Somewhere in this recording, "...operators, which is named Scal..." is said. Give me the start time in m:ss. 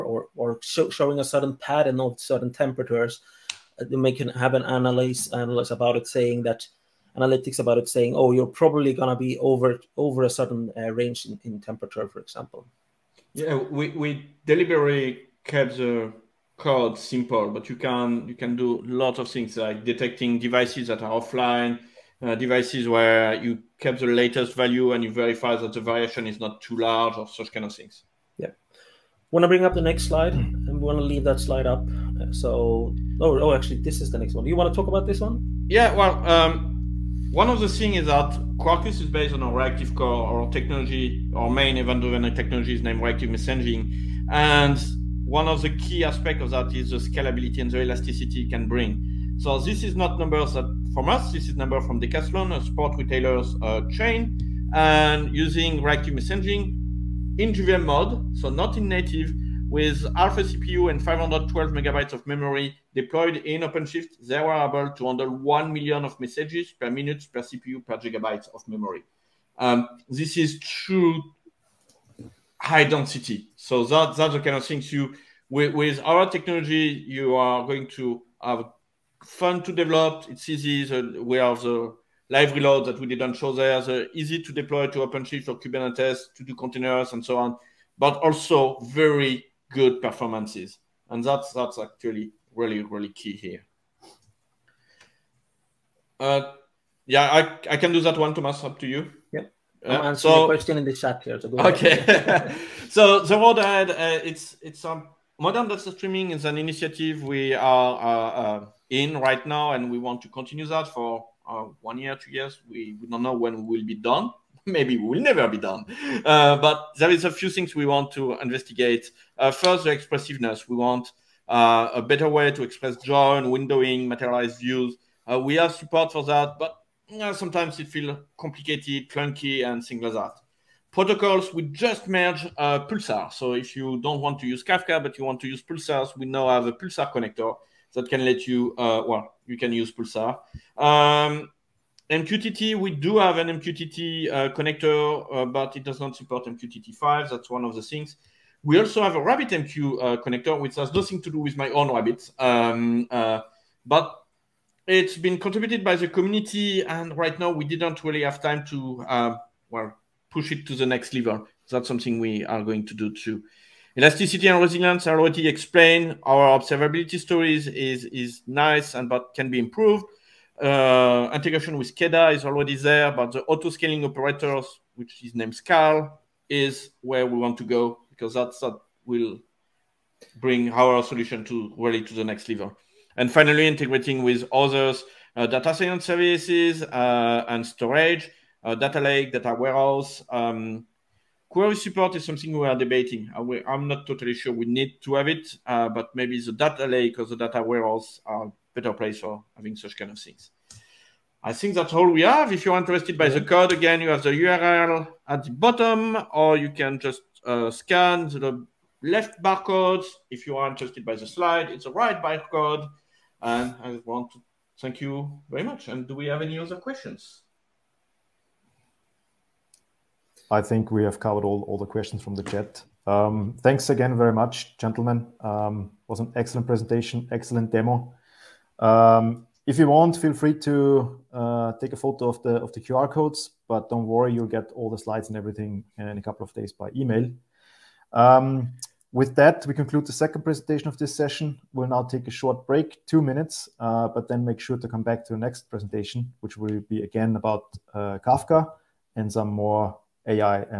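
2:54.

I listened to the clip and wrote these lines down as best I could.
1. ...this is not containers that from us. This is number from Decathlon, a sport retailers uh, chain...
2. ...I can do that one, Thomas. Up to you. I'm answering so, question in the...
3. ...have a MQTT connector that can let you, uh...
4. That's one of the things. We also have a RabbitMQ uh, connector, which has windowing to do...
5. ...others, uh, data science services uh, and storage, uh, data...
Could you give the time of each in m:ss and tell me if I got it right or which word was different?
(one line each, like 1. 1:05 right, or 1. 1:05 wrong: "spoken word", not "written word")
1. 0:49 wrong: "numbers", not "containers"
2. 1:37 right
3. 2:16 wrong: "Pulsar", not "MQTT"
4. 2:27 wrong: "nothing", not "windowing"
5. 3:04 right.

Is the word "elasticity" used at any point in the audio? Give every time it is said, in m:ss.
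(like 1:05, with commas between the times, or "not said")
0:47, 2:43.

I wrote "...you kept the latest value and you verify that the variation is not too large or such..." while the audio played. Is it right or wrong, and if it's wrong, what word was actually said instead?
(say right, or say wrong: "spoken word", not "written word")
right.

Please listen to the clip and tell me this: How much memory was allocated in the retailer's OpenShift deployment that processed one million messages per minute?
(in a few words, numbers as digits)
512 megabytes.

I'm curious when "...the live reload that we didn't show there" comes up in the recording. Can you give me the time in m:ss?
1:21.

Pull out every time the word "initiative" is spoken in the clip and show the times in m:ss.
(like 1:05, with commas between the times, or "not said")
1:46.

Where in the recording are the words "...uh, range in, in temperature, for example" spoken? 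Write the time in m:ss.
0:10.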